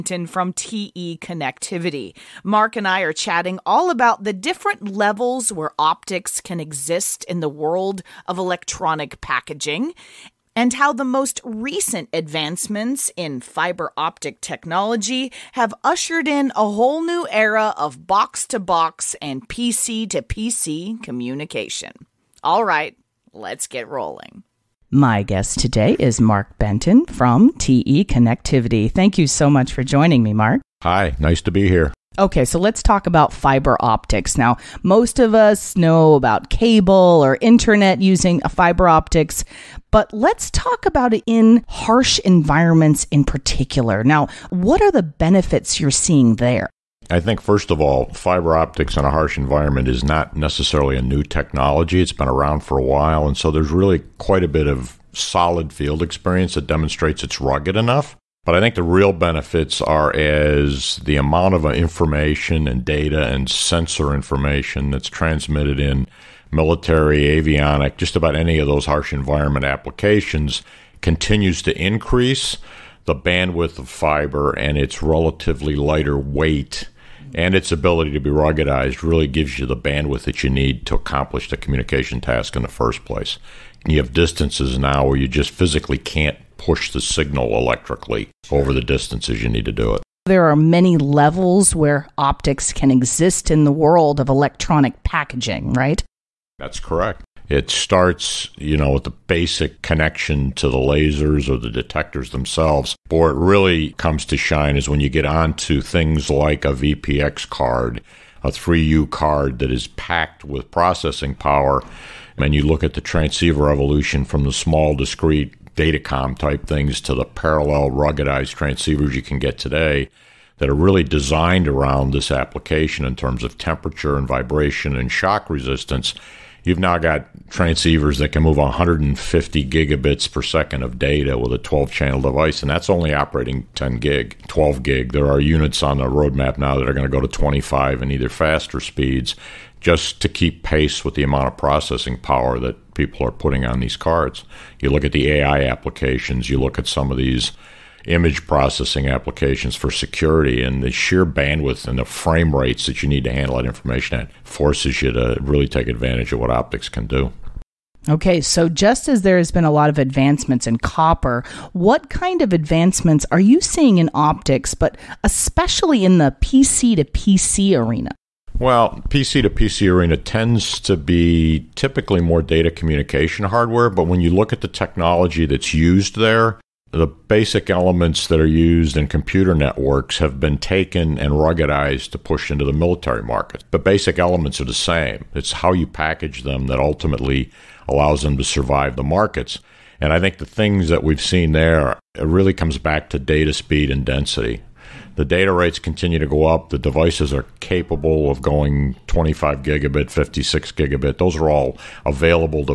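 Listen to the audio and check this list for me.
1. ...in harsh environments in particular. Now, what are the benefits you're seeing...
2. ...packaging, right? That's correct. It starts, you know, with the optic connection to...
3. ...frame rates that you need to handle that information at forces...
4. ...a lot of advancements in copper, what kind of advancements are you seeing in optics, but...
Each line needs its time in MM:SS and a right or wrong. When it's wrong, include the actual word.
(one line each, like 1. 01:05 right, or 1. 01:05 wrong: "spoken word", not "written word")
1. 00:41 right
2. 01:35 wrong: "basic", not "optic"
3. 02:32 right
4. 02:39 right.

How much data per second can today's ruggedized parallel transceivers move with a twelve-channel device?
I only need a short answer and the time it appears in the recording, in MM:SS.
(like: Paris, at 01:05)
150 gigabits per second, at 02:08.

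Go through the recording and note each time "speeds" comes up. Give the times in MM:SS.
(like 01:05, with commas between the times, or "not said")
02:18, 03:13.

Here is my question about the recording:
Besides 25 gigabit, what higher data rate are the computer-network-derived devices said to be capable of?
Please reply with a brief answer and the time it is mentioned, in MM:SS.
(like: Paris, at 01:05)
56 gigabit, at 03:20.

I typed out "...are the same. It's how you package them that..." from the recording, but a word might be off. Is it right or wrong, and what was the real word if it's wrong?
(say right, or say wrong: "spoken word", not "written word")
right.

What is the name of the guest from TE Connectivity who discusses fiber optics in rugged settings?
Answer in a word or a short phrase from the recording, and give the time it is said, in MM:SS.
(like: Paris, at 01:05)
Mark Benton, at 00:26.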